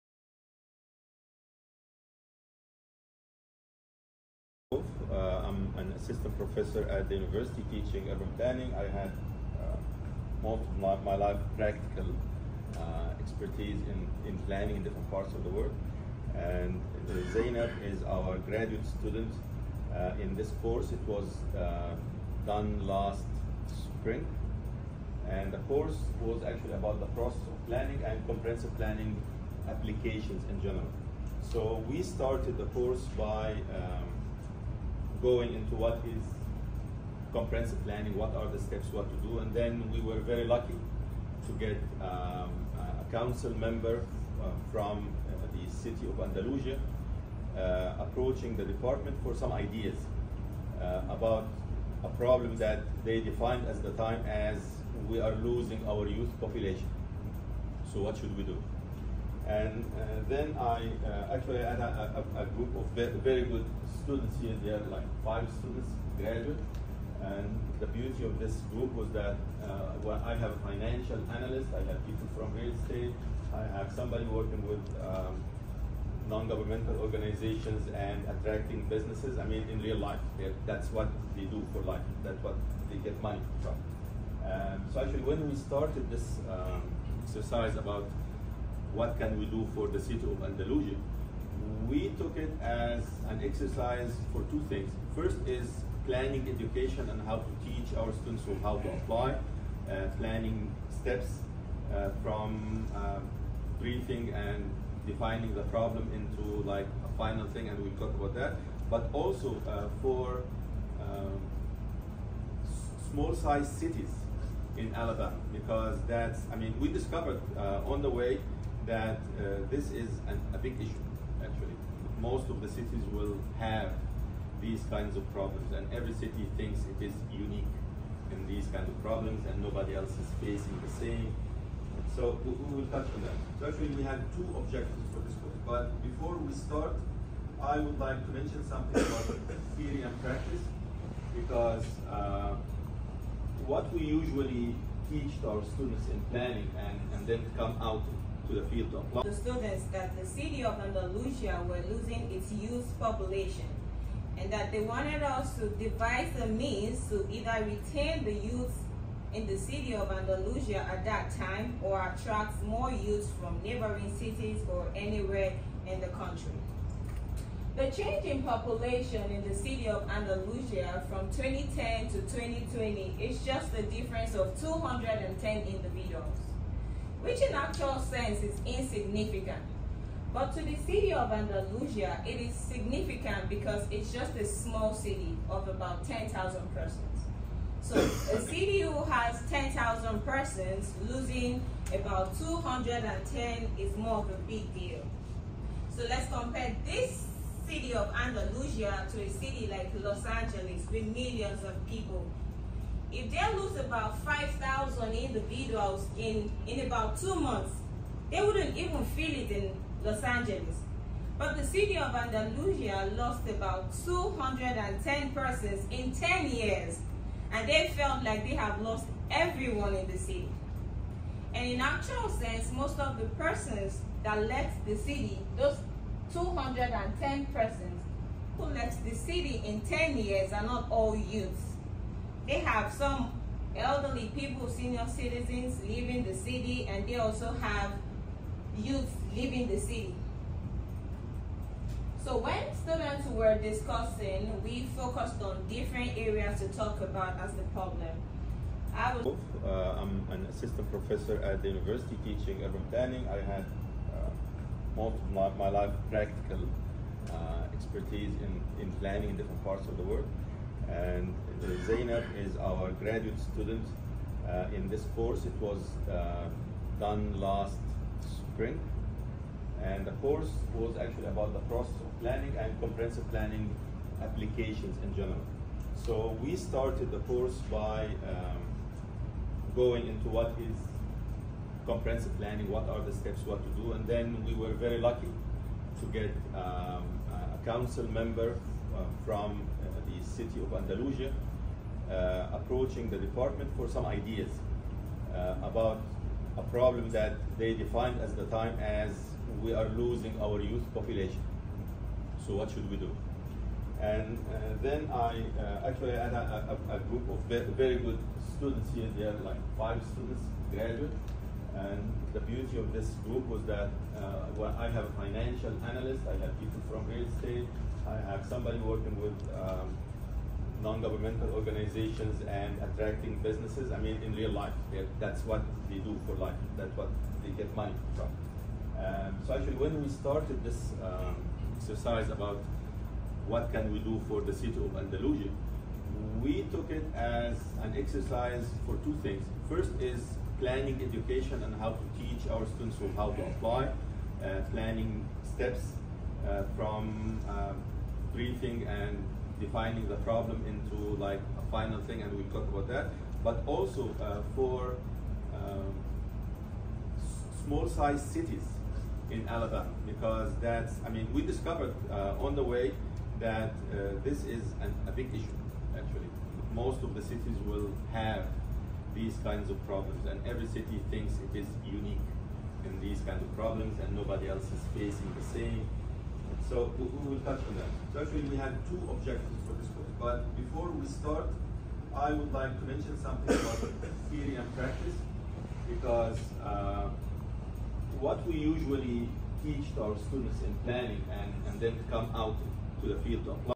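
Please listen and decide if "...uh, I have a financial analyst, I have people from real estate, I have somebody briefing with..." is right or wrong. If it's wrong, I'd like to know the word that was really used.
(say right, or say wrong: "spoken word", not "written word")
wrong: "working", not "briefing".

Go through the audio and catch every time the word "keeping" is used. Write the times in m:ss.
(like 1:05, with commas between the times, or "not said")
not said.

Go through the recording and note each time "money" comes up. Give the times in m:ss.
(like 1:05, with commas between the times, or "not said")
1:23, 5:27.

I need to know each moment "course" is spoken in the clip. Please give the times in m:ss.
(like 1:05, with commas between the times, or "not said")
0:20, 0:25, 0:32, 4:25, 4:30, 4:37, 6:19.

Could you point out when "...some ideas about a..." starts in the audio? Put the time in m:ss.
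4:53.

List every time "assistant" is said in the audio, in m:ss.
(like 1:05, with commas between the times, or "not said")
0:06, 4:10.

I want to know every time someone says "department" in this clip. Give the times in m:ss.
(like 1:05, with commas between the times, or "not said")
0:48, 4:53.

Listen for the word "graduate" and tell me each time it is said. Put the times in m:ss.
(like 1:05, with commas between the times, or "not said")
0:18, 1:06, 4:22, 5:10.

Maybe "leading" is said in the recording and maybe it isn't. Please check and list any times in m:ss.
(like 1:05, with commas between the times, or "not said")
not said.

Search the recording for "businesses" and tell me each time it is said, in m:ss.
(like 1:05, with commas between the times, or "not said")
1:18, 5:23.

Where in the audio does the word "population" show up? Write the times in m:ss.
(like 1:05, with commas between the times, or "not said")
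0:56, 2:32, 2:48, 5:00.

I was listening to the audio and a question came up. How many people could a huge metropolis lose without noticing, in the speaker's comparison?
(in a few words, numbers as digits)
5,000.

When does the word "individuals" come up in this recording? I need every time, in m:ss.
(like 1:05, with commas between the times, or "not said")
2:55, 3:25.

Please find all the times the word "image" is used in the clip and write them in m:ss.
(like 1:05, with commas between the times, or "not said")
not said.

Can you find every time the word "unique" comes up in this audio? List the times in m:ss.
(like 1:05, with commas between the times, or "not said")
2:07, 6:11.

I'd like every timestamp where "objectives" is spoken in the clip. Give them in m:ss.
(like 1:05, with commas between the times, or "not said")
2:14, 6:19.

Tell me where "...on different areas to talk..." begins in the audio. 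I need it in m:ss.
4:05.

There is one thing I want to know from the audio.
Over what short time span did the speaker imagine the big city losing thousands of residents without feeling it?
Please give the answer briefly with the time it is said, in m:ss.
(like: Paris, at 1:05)
two months, at 3:27.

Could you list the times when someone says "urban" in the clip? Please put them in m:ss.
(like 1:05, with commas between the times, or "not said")
0:08, 4:12.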